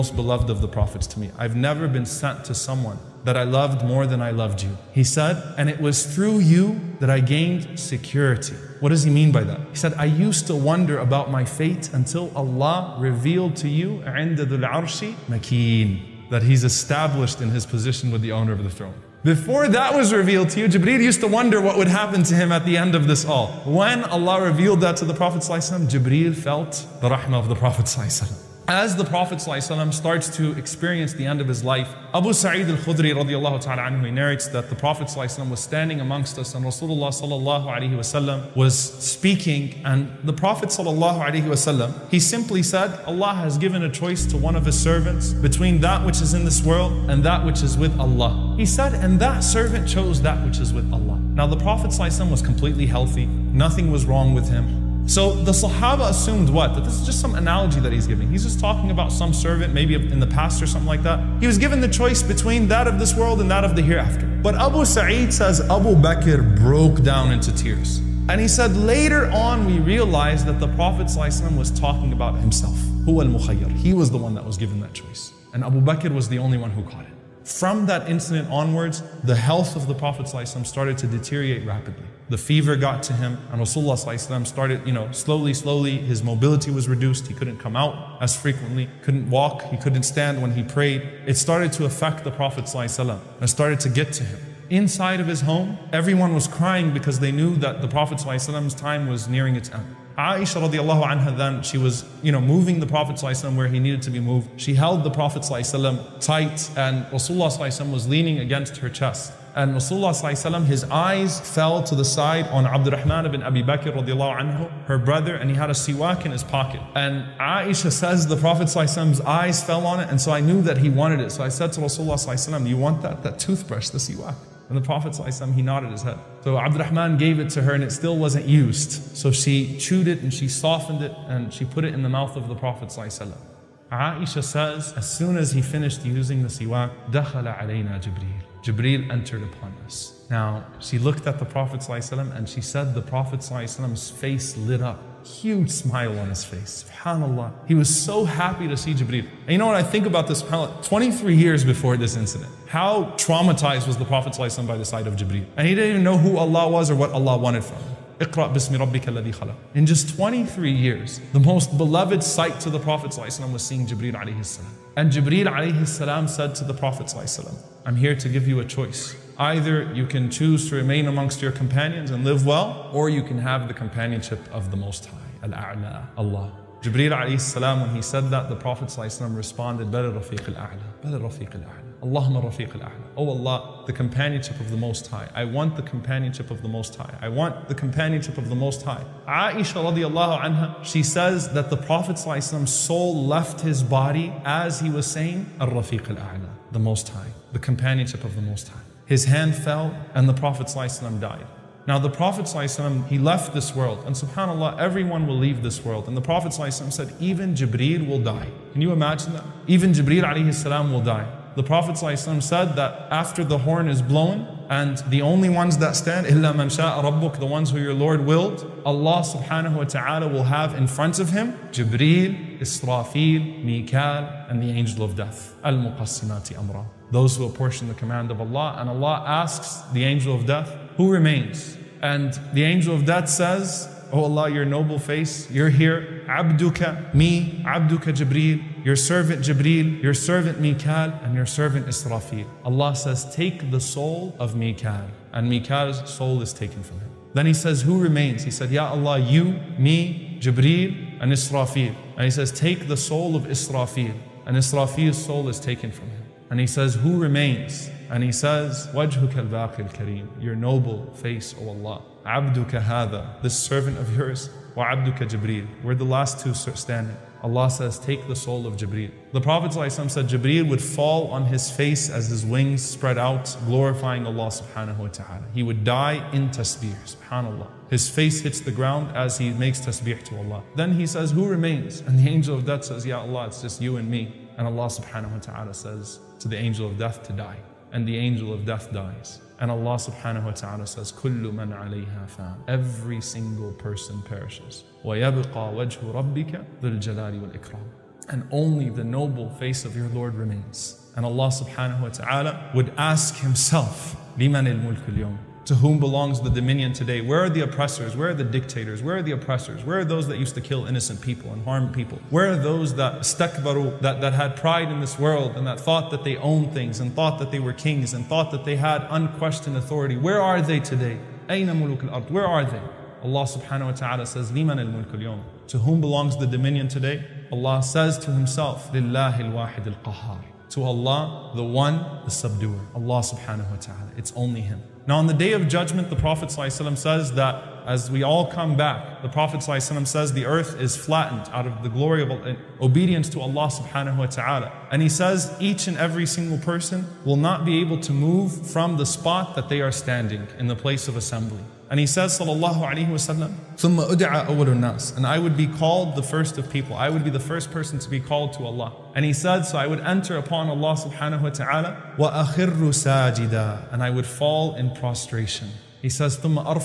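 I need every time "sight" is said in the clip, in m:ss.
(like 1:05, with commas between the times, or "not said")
2:34, 2:42.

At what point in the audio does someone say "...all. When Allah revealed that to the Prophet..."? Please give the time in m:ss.
0:23.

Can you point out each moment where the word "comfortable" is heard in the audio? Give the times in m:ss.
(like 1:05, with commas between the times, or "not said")
not said.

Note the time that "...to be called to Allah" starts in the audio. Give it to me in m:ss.
5:57.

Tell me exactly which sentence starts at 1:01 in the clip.
He was given the choice between that of this world and that of the hereafter.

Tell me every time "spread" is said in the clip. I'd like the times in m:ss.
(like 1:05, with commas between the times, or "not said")
4:32.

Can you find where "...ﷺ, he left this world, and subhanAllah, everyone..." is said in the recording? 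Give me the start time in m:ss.
3:22.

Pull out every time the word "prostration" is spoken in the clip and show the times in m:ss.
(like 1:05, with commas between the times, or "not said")
6:04.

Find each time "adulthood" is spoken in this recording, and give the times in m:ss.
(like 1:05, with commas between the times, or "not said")
not said.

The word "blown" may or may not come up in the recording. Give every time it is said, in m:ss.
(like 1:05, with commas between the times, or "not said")
3:34.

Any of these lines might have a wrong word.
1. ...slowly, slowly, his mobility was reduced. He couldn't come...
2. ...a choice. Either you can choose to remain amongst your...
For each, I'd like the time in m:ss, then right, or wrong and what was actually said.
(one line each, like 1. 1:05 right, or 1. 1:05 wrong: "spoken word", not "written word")
1. 1:25 right
2. 2:48 right.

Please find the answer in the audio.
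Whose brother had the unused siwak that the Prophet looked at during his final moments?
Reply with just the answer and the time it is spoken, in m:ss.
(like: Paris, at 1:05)
Abdurrahman ibn Abi Bakr, at 1:52.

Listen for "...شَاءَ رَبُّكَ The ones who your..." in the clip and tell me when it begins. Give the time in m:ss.
3:36.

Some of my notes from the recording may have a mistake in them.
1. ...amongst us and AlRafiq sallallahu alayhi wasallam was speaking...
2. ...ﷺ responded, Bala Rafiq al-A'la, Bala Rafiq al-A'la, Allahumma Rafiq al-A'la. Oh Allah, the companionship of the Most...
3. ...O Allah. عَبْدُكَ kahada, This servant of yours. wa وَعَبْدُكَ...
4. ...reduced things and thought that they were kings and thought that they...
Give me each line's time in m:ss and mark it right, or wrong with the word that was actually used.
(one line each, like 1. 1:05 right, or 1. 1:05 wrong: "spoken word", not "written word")
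1. 0:35 wrong: "Rasulullah", not "AlRafiq"
2. 2:58 right
3. 4:21 right
4. 5:16 wrong: "owned", not "reduced".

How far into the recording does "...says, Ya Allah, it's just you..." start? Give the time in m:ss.
4:42.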